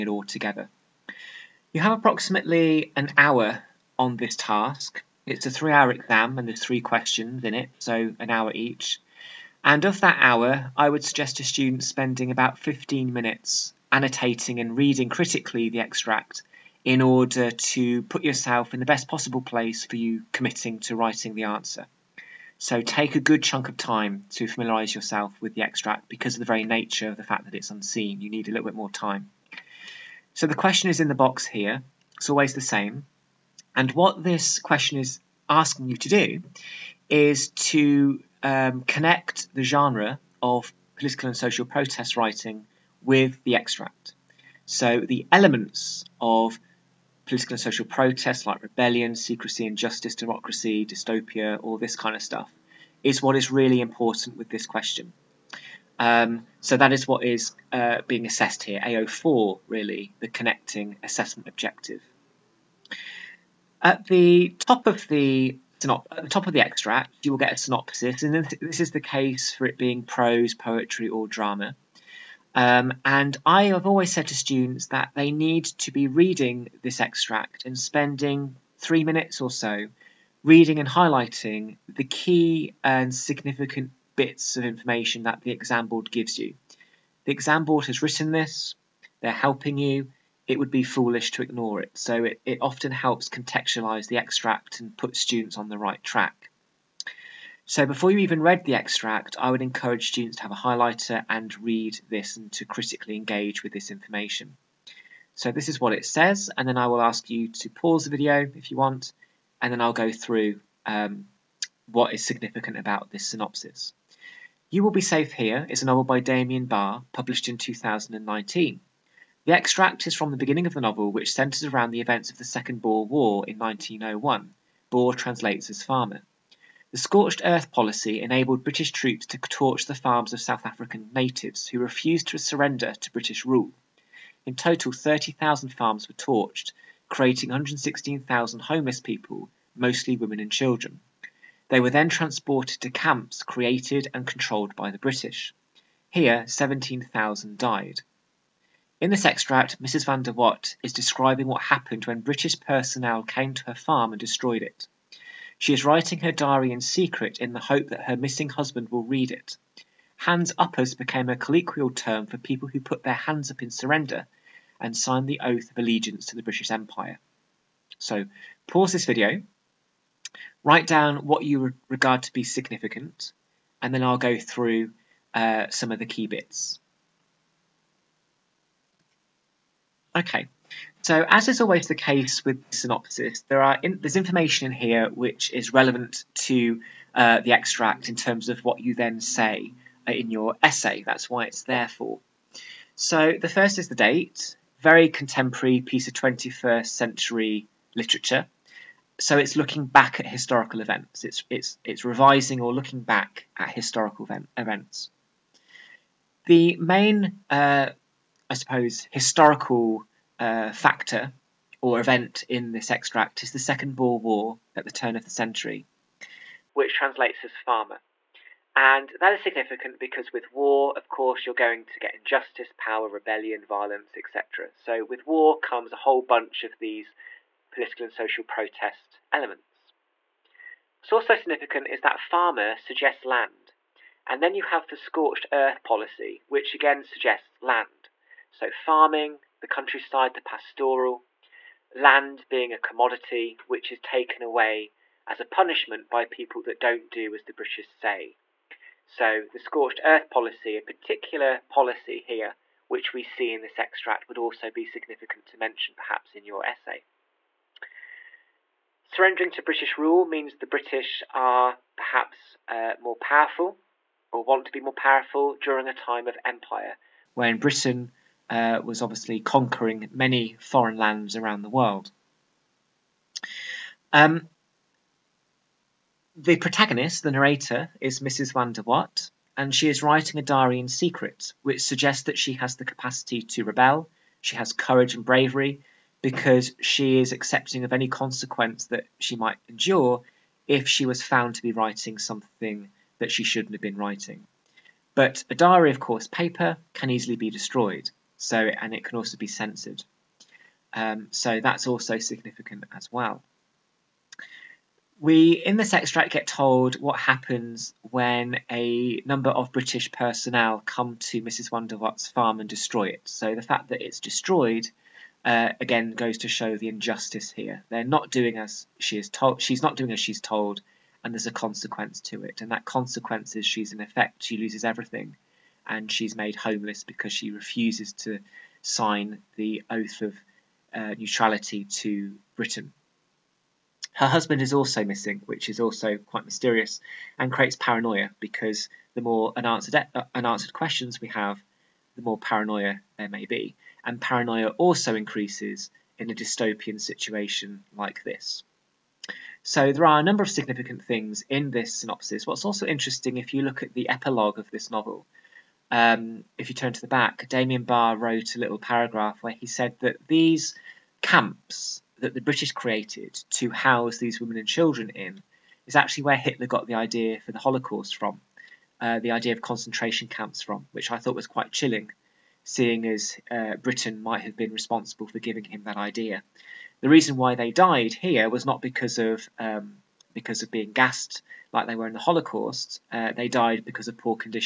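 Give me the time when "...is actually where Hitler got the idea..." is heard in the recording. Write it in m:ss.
6:05.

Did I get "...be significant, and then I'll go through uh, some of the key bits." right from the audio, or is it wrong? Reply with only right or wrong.
right.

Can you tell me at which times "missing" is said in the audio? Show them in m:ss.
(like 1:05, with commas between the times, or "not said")
2:38, 5:35.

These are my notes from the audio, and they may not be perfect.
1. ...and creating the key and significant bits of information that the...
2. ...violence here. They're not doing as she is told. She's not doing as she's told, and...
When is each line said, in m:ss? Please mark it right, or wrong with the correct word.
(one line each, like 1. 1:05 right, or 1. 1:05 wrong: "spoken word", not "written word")
1. 1:20 wrong: "highlighting", not "creating"
2. 5:16 wrong: "injustice", not "violence".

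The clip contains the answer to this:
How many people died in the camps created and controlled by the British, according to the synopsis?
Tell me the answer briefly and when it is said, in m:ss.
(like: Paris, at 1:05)
17,000, at 2:26.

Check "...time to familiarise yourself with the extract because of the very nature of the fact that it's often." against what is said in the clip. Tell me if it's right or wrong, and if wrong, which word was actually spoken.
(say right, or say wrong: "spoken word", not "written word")
wrong: "unseen", not "often".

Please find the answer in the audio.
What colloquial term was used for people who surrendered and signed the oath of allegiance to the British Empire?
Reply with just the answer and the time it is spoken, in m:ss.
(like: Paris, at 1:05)
Hands uppers, at 2:40.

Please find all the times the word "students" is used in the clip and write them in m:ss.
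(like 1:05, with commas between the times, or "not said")
0:11, 1:14, 1:35, 1:40.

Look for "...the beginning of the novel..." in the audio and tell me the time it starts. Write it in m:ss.
2:00.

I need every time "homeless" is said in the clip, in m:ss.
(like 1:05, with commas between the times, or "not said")
2:18, 5:26.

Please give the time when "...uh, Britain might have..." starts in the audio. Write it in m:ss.
6:13.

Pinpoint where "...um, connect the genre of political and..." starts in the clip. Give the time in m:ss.
0:38.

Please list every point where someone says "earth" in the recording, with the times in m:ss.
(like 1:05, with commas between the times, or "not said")
2:07, 3:55, 4:10.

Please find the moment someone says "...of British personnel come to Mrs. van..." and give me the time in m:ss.
5:09.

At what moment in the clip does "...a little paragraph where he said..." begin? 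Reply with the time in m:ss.
5:58.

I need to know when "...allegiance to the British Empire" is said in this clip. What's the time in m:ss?
2:45.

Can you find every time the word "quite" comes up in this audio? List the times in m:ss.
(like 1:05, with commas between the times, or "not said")
5:36, 6:11.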